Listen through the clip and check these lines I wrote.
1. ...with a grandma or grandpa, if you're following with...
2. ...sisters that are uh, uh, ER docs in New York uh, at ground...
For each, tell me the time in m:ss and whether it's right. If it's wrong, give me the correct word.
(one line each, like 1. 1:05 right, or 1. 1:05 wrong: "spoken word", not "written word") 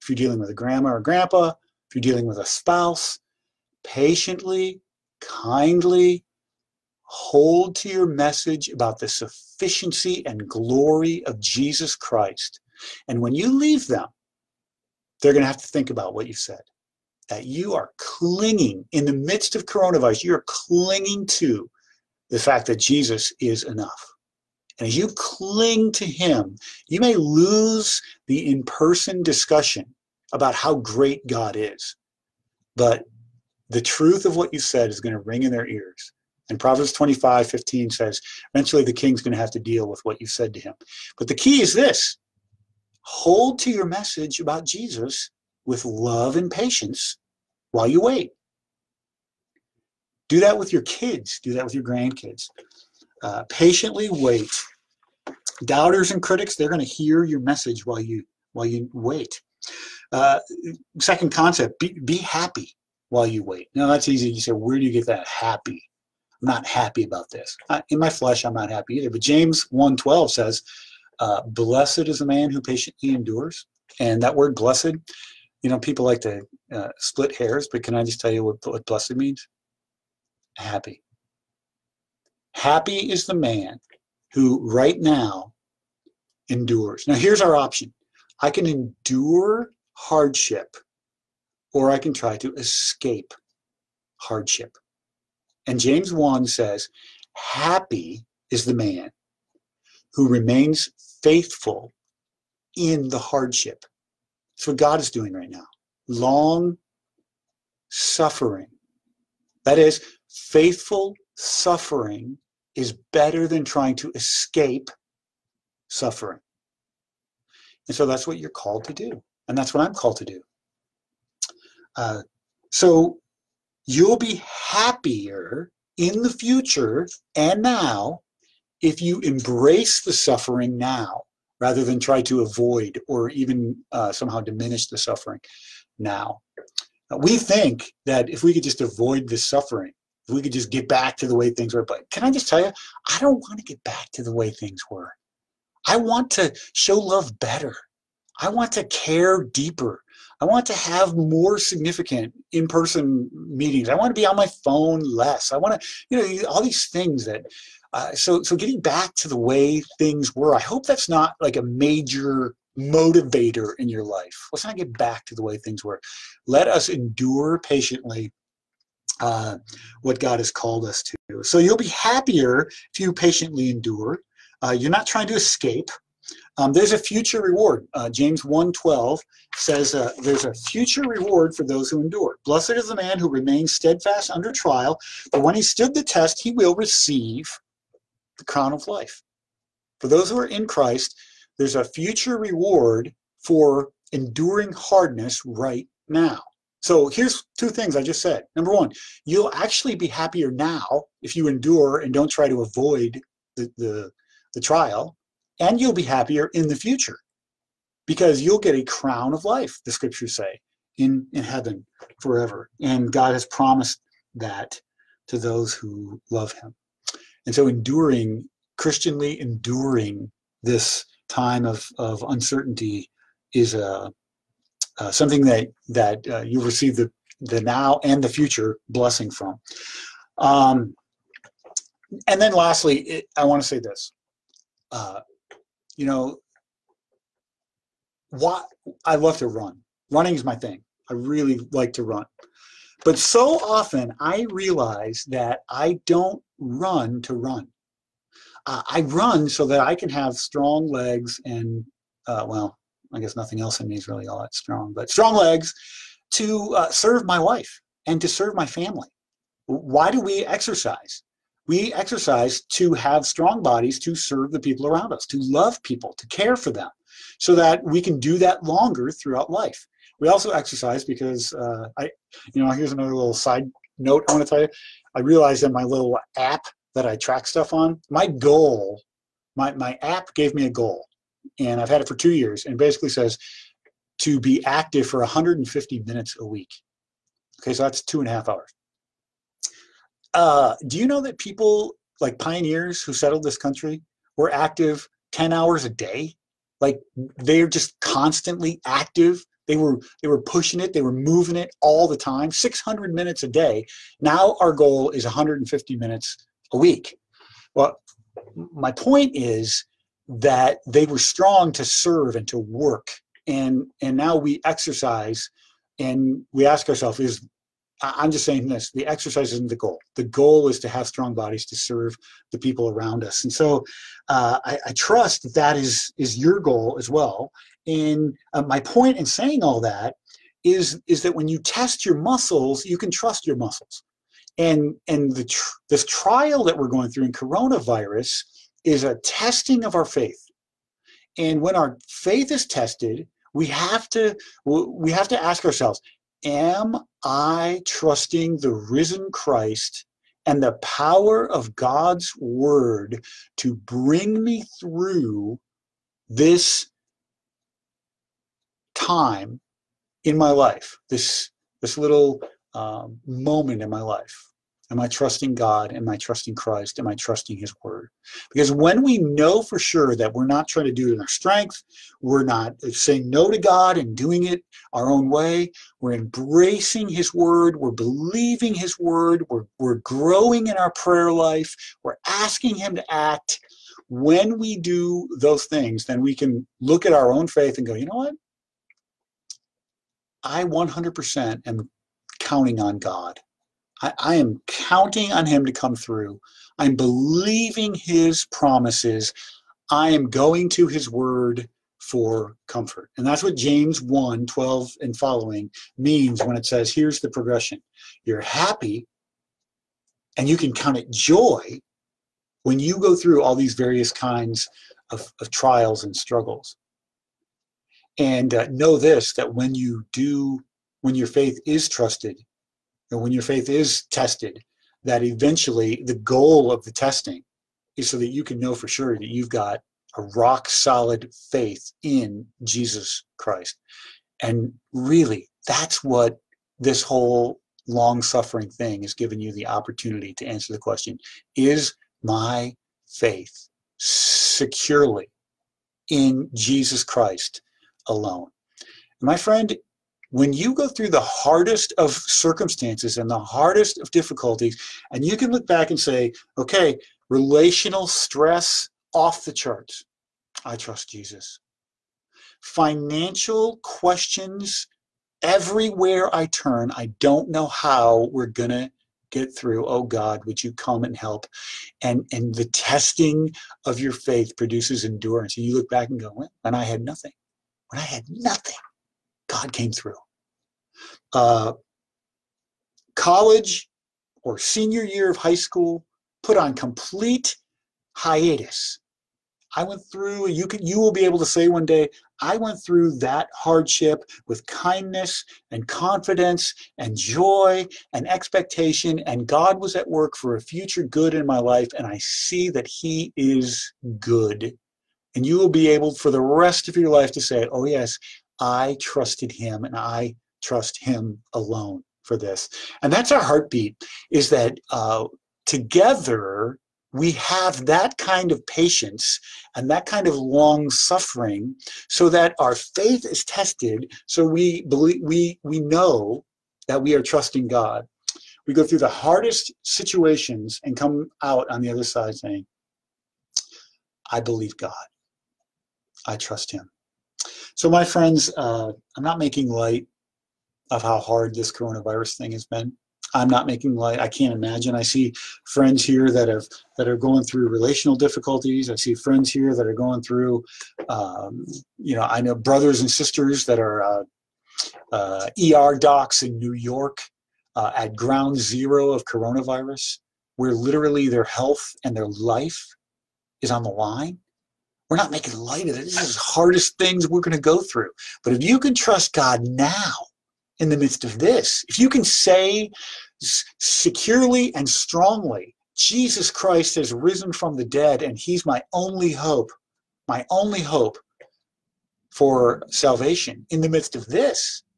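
1. 0:00 wrong: "dealing", not "following"
2. 9:13 right.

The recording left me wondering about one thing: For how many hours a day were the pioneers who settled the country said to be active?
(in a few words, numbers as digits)
10.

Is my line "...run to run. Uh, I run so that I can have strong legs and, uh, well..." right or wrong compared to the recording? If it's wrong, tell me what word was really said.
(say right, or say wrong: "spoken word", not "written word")
right.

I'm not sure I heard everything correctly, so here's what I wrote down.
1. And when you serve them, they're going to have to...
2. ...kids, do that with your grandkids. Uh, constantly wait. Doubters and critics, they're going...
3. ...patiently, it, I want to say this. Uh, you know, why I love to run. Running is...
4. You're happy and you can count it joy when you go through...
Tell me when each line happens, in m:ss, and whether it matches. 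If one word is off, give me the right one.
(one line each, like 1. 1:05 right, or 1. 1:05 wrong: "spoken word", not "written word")
1. 0:13 wrong: "leave", not "serve"
2. 0:50 wrong: "patiently", not "constantly"
3. 3:52 wrong: "lastly", not "patiently"
4. 6:48 right.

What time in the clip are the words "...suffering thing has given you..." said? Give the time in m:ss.
7:18.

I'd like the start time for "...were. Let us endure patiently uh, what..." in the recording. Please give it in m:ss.
2:45.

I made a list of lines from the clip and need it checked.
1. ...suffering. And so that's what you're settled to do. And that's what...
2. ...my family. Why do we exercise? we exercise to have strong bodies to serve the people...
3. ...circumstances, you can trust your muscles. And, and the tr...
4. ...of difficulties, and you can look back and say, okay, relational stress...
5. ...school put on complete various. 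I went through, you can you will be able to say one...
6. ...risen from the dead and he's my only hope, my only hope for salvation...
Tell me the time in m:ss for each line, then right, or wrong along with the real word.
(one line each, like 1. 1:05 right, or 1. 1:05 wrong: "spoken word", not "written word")
1. 1:55 wrong: "called", not "settled"
2. 4:18 right
3. 5:32 wrong: "muscles", not "circumstances"
4. 7:33 right
5. 8:05 wrong: "hiatus", not "various"
6. 9:37 right.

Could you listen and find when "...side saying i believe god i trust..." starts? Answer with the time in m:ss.
8:52.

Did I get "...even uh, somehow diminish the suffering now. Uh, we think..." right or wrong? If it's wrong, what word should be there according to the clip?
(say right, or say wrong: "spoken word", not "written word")
right.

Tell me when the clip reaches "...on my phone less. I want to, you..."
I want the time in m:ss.
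2:34.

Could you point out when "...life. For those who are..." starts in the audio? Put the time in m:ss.
3:08.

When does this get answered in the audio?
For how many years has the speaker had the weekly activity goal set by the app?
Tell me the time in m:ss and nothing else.
4:42.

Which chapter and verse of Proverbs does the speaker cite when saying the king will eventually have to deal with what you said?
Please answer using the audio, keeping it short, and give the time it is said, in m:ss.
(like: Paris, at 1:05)
Proverbs 25:15, at 0:36.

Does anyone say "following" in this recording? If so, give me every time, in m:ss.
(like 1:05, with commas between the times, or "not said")
6:45.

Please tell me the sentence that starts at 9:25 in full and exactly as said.
We're not making light of it.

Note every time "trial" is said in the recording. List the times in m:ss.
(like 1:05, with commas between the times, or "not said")
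3:04, 3:24, 5:36, 6:55.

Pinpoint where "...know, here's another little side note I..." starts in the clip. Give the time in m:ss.
4:32.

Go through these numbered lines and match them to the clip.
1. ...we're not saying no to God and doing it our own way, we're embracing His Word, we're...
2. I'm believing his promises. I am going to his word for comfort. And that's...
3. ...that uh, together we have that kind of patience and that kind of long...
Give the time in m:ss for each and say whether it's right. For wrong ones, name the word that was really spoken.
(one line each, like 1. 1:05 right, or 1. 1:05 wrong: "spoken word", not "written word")
1. 6:12 right
2. 6:36 right
3. 8:34 right.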